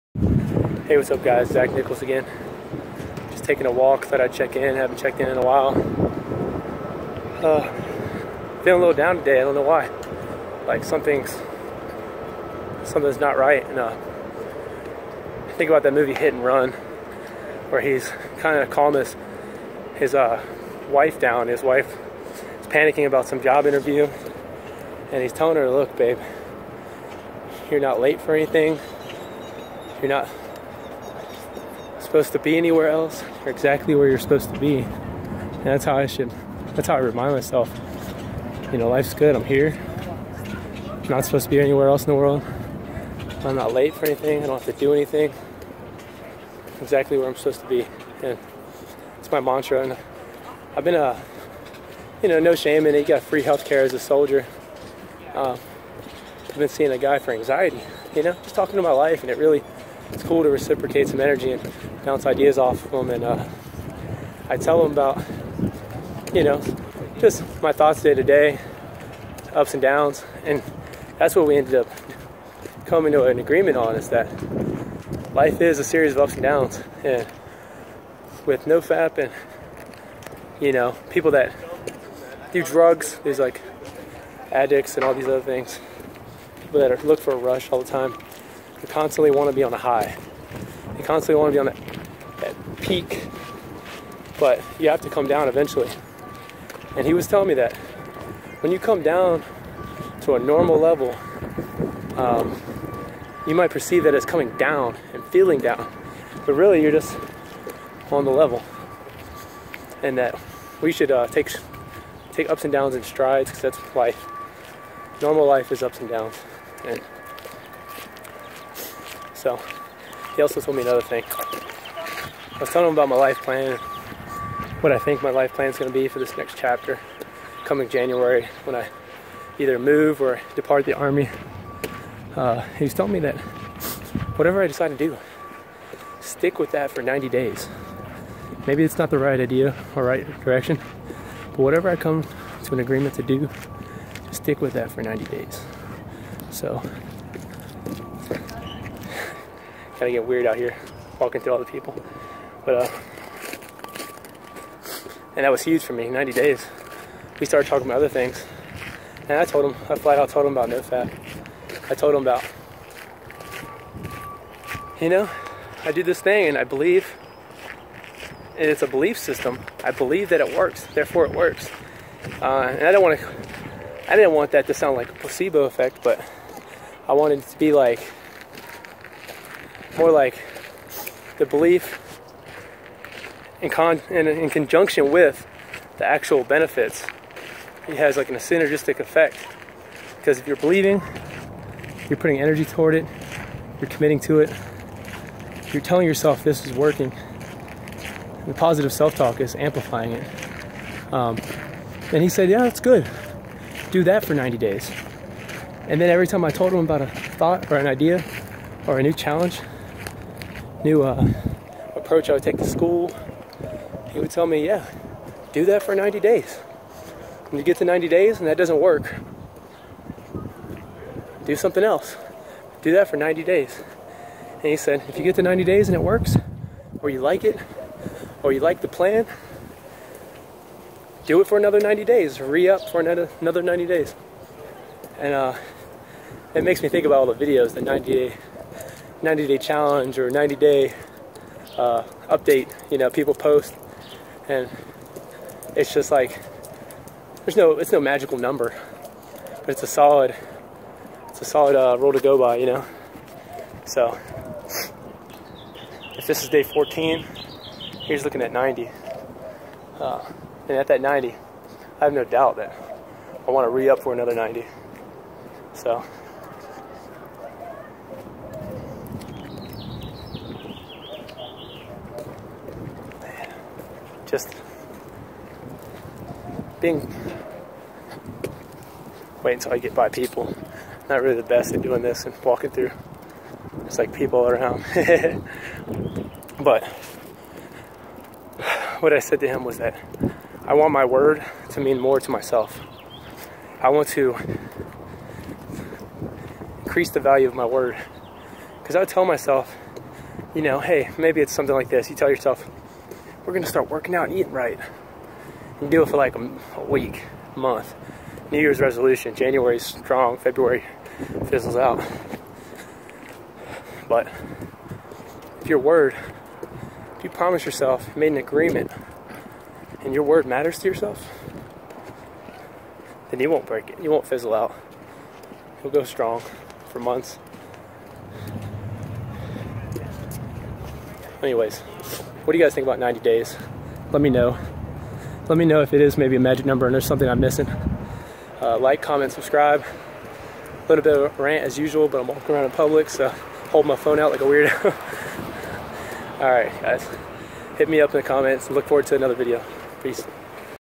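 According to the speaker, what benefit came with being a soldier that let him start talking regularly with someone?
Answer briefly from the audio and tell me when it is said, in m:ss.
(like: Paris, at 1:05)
free health care, at 0:53.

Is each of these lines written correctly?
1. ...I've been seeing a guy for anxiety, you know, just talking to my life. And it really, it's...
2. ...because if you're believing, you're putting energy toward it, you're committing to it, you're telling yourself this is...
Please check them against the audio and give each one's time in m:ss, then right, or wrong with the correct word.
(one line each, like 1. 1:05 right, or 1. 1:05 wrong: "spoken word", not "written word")
1. 0:56 right
2. 3:10 right.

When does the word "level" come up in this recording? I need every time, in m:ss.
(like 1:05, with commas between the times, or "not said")
1:40, 1:48.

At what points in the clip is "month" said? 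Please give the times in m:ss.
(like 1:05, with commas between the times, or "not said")
5:07, 5:26.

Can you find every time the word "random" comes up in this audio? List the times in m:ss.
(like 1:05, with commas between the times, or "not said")
not said.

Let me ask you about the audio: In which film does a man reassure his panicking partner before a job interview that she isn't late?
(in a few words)
Hit and Run.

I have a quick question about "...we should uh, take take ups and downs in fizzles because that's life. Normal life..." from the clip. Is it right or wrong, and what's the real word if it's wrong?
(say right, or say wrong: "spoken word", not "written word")
wrong: "strides", not "fizzles".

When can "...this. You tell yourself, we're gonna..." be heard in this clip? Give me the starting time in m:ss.
5:01.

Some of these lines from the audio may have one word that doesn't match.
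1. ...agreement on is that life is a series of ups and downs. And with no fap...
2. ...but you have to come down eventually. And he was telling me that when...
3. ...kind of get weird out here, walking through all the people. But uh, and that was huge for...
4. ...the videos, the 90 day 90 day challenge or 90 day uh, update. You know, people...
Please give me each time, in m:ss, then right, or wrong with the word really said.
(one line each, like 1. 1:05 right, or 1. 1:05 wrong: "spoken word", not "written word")
1. 1:13 right
2. 1:34 right
3. 2:30 right
4. 3:57 right.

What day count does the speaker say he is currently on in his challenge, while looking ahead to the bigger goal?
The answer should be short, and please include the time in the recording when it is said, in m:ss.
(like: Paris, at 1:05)
14, at 4:16.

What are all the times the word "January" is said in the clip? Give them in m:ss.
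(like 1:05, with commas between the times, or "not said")
2:07, 5:09.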